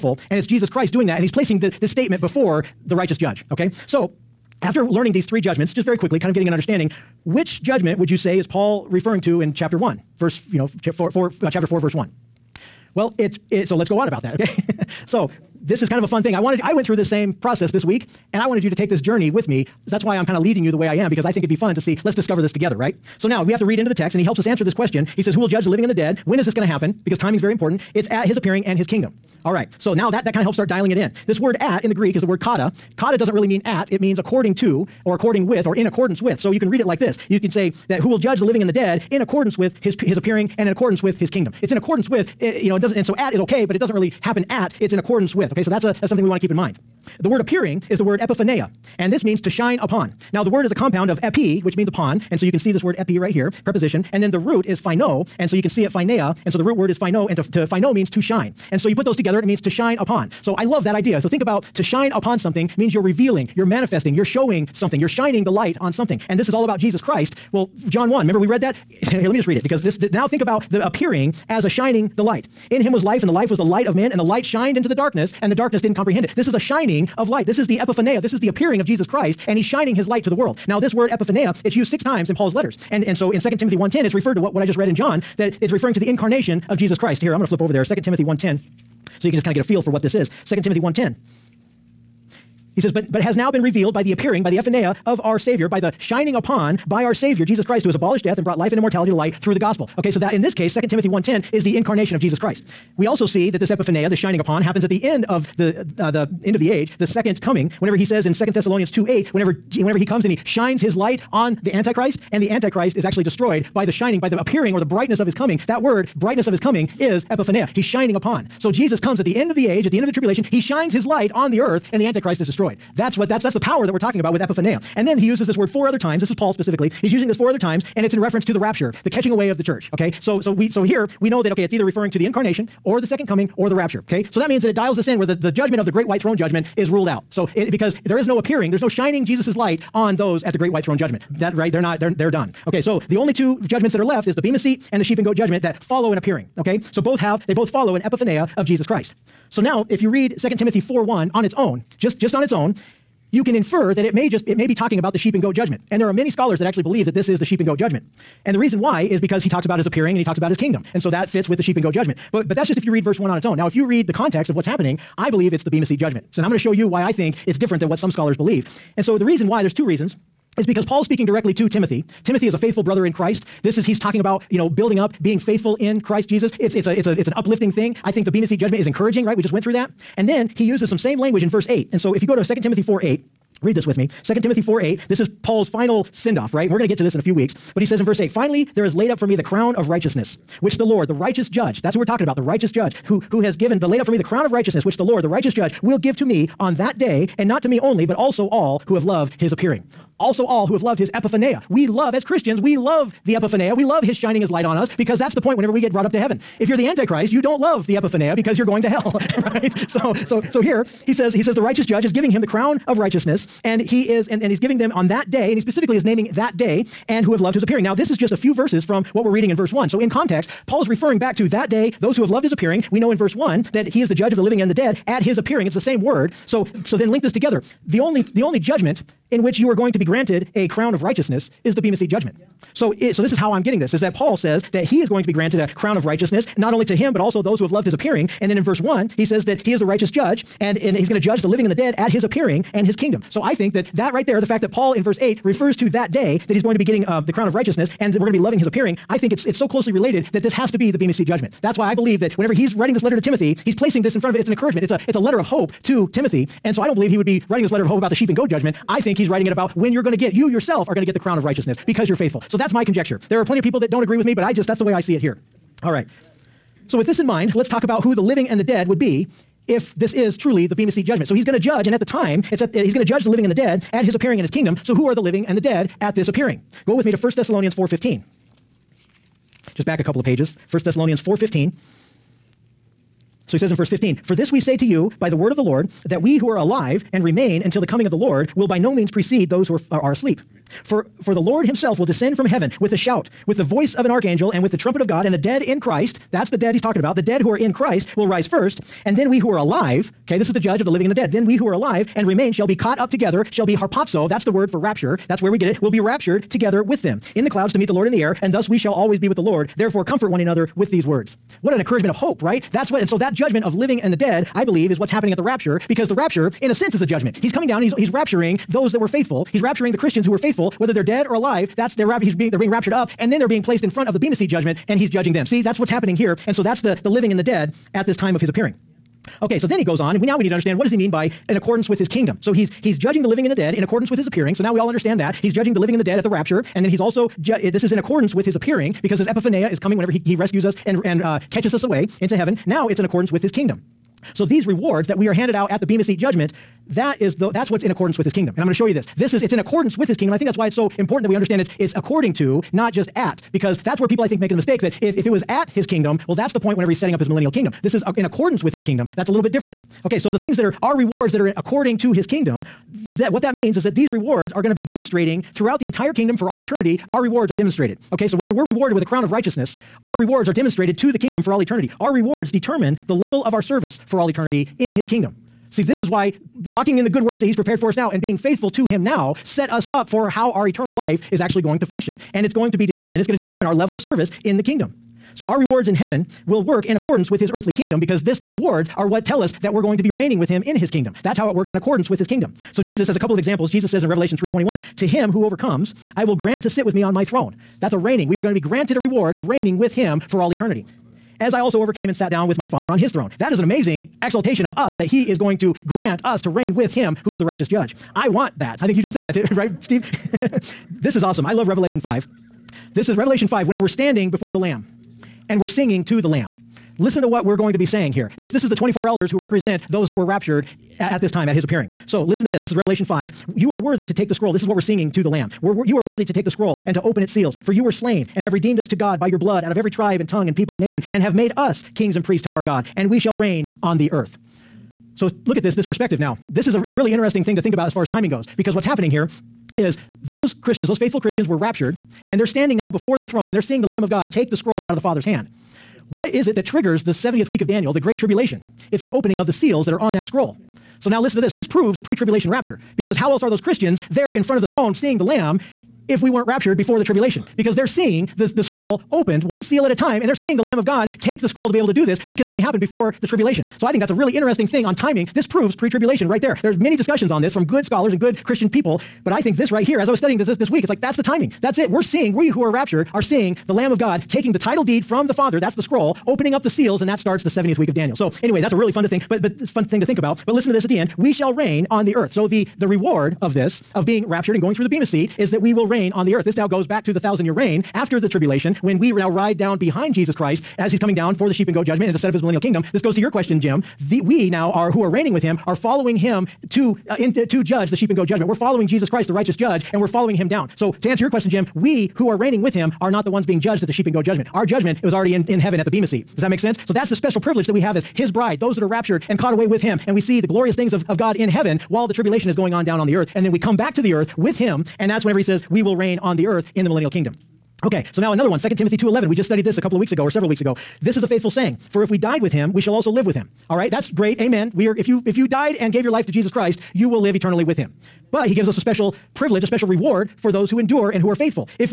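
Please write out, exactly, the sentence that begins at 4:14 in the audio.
It's an encouragement, it's a, it's a letter of hope to Timothy.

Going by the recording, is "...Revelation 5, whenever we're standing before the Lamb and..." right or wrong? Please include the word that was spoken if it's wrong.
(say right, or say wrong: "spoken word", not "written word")
right.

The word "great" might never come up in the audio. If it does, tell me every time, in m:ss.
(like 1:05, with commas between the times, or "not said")
2:15, 2:20, 7:27, 8:44.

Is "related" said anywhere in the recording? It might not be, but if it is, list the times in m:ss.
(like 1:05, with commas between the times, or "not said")
4:09.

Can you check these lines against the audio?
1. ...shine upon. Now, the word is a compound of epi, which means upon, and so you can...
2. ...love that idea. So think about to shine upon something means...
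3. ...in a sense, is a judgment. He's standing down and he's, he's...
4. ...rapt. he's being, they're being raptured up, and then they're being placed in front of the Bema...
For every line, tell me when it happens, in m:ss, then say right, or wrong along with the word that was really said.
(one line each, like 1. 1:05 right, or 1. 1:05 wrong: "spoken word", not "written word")
1. 0:49 right
2. 1:00 right
3. 5:16 wrong: "coming", not "standing"
4. 5:22 right.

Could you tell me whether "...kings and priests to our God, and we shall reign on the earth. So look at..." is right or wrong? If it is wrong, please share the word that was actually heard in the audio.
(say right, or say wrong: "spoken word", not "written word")
right.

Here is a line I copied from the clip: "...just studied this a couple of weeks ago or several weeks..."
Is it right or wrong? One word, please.
right.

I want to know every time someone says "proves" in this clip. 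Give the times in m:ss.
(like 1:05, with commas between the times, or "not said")
7:31, 7:45.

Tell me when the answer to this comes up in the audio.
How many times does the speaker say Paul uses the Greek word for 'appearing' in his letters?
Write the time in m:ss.
1:21.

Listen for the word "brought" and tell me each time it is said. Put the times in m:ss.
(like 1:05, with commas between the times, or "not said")
1:38, 3:25.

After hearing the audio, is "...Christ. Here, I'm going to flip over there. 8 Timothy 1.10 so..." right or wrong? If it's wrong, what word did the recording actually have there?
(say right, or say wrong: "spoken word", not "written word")
wrong: "2", not "8".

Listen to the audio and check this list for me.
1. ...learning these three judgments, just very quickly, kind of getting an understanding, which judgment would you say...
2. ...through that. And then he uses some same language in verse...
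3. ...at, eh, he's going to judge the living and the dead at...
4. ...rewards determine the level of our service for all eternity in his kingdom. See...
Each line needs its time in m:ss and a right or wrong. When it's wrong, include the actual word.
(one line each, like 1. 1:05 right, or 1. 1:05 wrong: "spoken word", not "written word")
1. 0:04 right
2. 2:59 right
3. 4:32 right
4. 6:12 right.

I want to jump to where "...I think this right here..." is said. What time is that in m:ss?
7:49.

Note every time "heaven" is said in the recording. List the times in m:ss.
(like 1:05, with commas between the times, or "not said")
3:26, 4:52, 5:42, 6:25, 8:25, 8:31.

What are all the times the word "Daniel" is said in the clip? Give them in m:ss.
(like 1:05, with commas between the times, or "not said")
7:27, 7:57.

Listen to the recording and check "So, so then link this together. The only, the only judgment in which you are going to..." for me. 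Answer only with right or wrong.
right.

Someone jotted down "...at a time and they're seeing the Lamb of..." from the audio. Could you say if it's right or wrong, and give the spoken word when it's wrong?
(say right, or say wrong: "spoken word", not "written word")
right.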